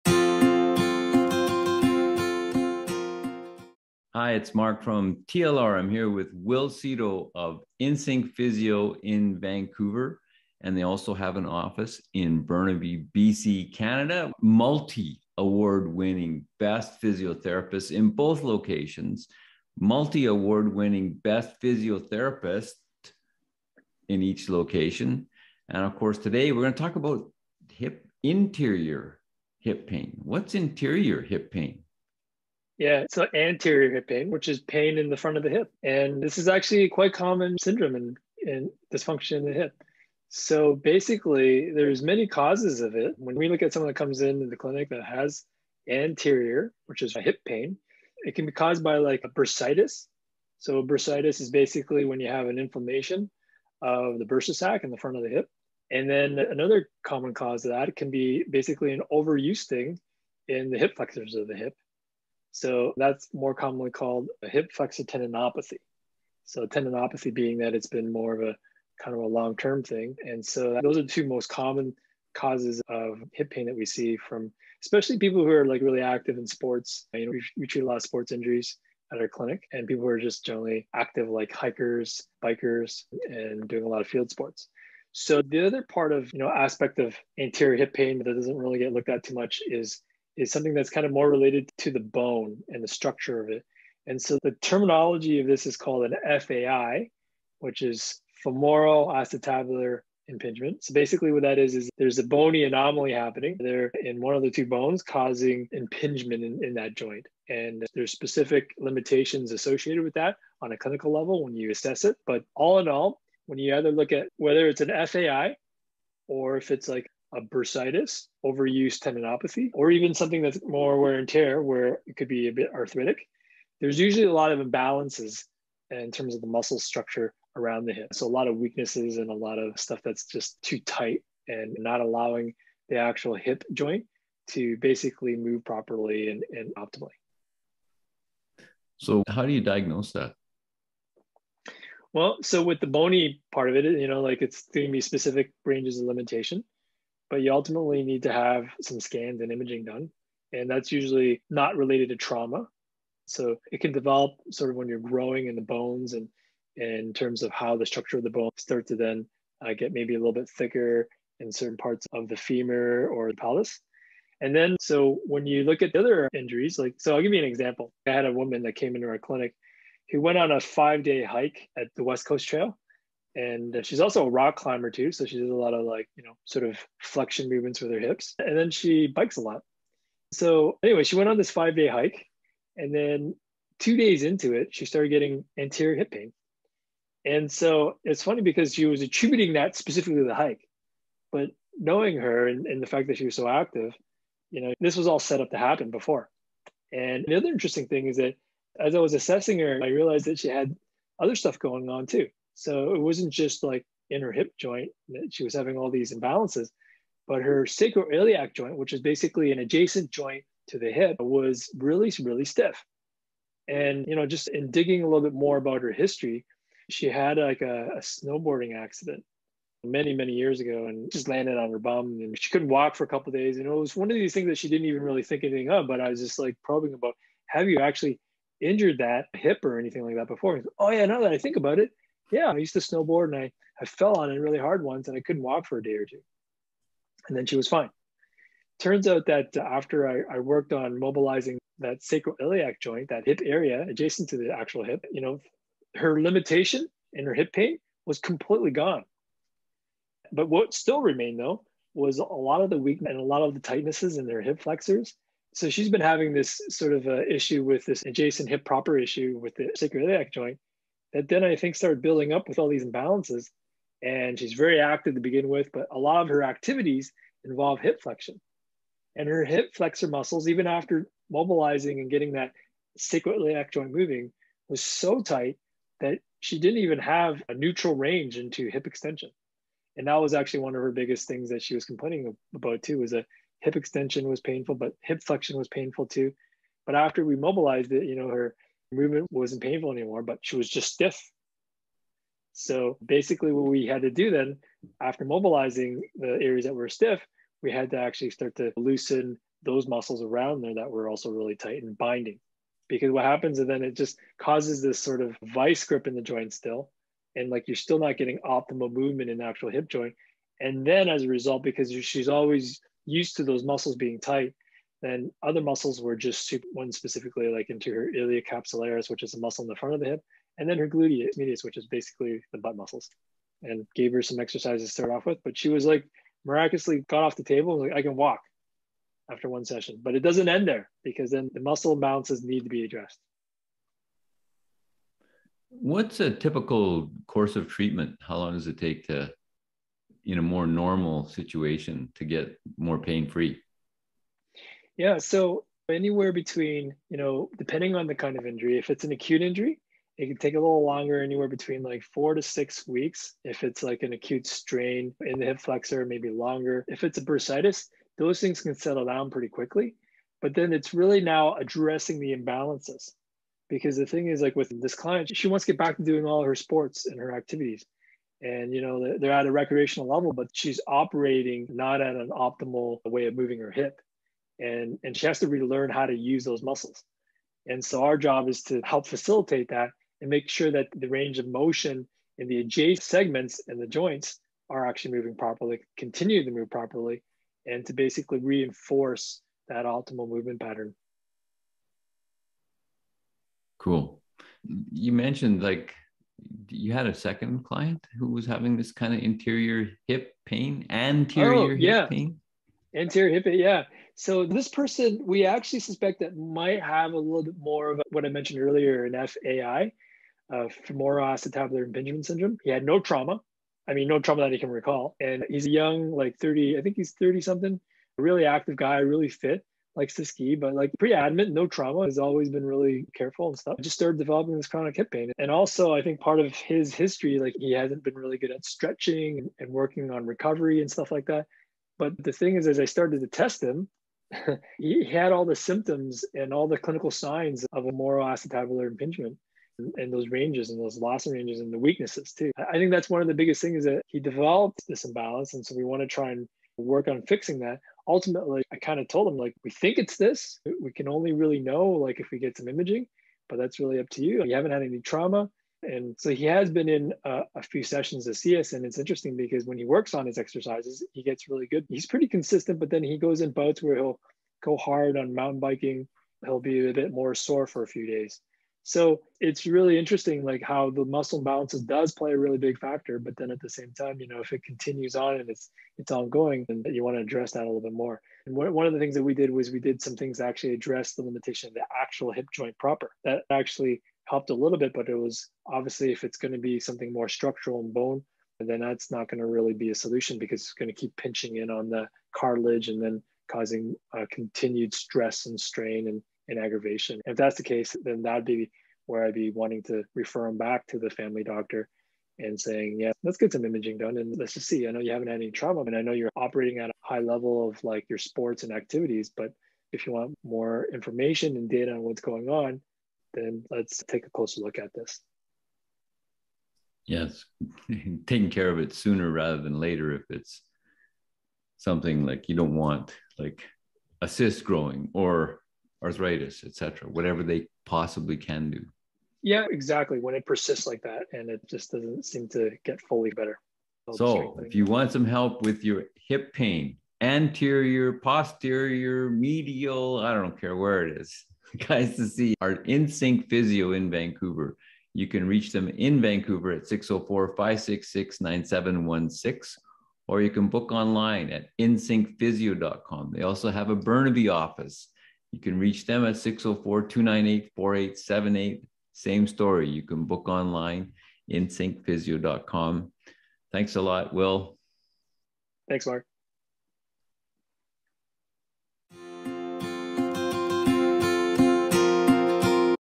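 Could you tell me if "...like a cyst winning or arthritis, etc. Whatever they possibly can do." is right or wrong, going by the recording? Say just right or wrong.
wrong.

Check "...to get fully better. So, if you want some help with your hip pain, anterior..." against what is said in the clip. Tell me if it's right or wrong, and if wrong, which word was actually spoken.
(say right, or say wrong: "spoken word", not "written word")
right.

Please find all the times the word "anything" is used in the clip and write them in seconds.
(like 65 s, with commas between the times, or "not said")
225 s, 229 s.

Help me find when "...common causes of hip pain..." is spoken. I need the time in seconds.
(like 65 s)
71 s.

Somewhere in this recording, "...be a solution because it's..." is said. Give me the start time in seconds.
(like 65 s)
489 s.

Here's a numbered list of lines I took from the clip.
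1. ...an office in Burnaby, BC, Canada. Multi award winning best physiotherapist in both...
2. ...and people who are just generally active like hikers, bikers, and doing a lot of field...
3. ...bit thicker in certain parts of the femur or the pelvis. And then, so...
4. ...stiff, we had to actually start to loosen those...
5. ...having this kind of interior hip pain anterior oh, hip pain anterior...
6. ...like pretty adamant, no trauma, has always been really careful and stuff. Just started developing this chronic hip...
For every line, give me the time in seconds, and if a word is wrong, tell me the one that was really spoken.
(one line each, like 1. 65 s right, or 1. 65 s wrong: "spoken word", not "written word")
1. 11 s right
2. 79 s right
3. 160 s right
4. 296 s right
5. 398 s right
6. 420 s right.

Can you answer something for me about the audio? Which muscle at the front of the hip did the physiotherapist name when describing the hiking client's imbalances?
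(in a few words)
iliocapsularis.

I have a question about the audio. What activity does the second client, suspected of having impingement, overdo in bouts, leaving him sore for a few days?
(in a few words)
mountain biking.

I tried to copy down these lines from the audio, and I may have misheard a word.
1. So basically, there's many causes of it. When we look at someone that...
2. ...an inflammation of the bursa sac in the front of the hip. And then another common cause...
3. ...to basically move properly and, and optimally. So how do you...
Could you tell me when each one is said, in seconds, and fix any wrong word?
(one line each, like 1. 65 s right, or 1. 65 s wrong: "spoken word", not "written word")
1. 40 s right
2. 52 s right
3. 134 s right.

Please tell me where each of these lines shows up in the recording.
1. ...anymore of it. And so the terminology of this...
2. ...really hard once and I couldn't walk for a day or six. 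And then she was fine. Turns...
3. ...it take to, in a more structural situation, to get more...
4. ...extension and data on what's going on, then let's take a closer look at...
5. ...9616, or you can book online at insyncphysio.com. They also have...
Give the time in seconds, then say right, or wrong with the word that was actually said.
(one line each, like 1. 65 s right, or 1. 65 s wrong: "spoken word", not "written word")
1. 92 s wrong: "structure", not "anymore"
2. 234 s wrong: "two", not "six"
3. 338 s wrong: "normal", not "structural"
4. 510 s wrong: "information", not "extension"
5. 548 s wrong: "9716", not "9616".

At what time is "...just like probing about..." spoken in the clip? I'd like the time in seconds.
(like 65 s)
226 s.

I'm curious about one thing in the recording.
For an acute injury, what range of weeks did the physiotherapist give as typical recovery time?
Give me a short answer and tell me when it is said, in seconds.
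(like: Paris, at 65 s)
4 to 6 weeks, at 352 s.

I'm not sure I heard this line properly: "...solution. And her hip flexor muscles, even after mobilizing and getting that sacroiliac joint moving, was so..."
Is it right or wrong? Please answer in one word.
wrong.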